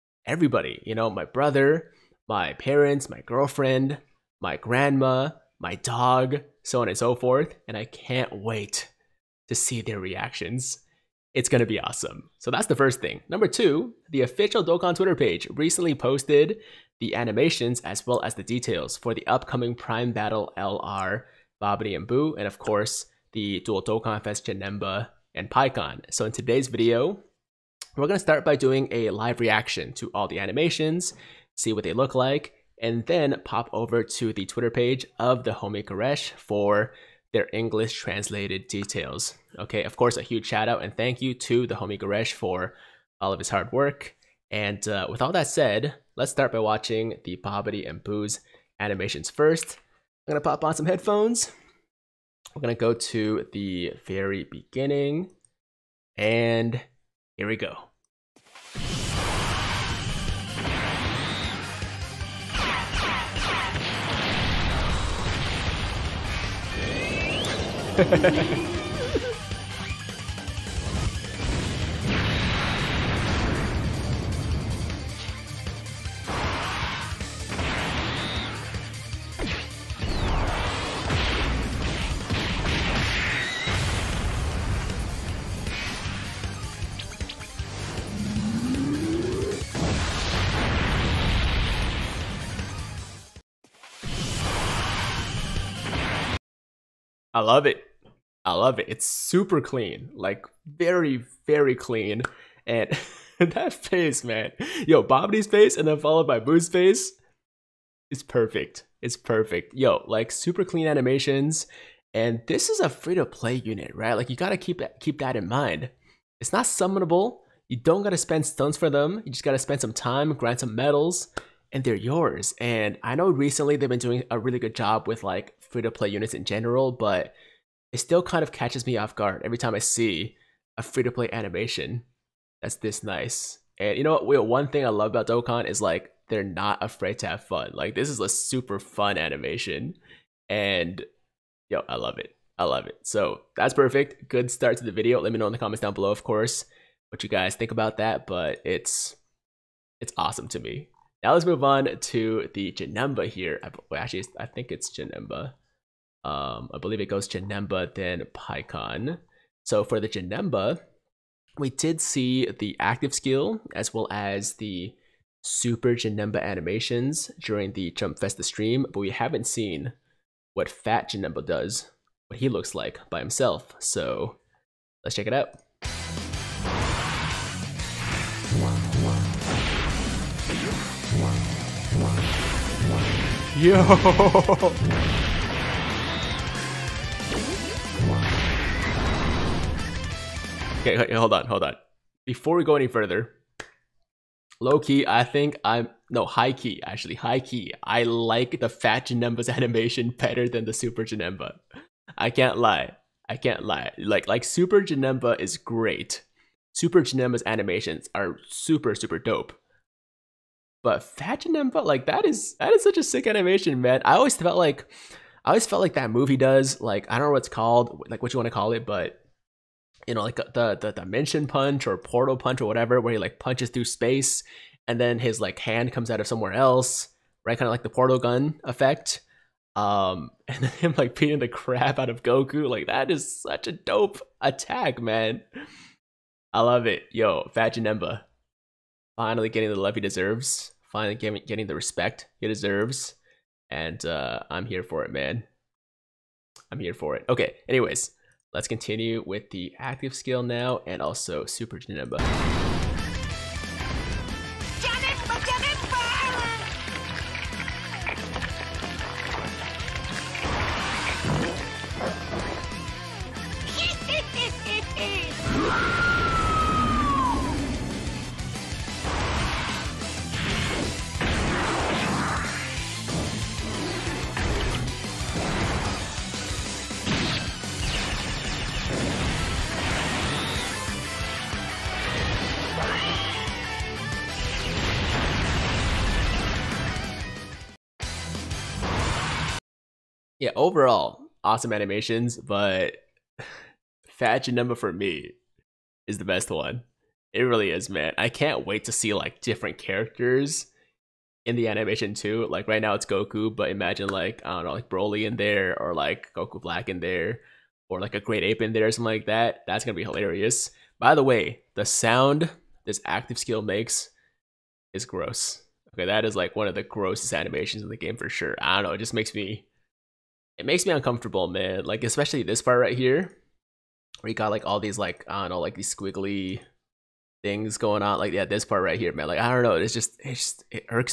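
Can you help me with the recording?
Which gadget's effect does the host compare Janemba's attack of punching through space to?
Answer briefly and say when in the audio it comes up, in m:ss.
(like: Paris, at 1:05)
the portal gun, at 3:47.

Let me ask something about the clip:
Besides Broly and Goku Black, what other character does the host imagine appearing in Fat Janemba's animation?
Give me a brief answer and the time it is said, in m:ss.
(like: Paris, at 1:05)
a Great Ape, at 5:08.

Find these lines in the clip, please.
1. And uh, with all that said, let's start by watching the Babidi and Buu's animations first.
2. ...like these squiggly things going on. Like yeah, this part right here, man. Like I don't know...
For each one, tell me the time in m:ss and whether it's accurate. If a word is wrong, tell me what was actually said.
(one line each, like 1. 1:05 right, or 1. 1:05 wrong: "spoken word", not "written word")
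1. 0:44 right
2. 5:25 right.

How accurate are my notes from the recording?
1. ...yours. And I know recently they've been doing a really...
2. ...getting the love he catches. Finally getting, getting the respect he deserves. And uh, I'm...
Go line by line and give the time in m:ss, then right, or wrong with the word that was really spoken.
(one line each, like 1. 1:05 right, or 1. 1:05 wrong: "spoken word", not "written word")
1. 2:01 right
2. 3:59 wrong: "deserves", not "catches".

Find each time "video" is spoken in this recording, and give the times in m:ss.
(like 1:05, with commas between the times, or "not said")
0:26, 2:24.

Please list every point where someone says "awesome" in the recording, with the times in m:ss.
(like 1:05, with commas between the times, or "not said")
0:11, 2:30, 4:51.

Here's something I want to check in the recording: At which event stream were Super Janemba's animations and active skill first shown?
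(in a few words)
Jump Festa.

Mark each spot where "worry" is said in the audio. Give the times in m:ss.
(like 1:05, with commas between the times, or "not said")
not said.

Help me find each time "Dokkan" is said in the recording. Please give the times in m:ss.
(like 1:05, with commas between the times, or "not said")
0:14, 0:23, 2:15.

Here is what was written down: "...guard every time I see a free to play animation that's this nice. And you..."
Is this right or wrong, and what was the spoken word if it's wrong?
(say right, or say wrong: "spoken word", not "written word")
right.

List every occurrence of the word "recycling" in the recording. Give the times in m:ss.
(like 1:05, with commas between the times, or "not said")
not said.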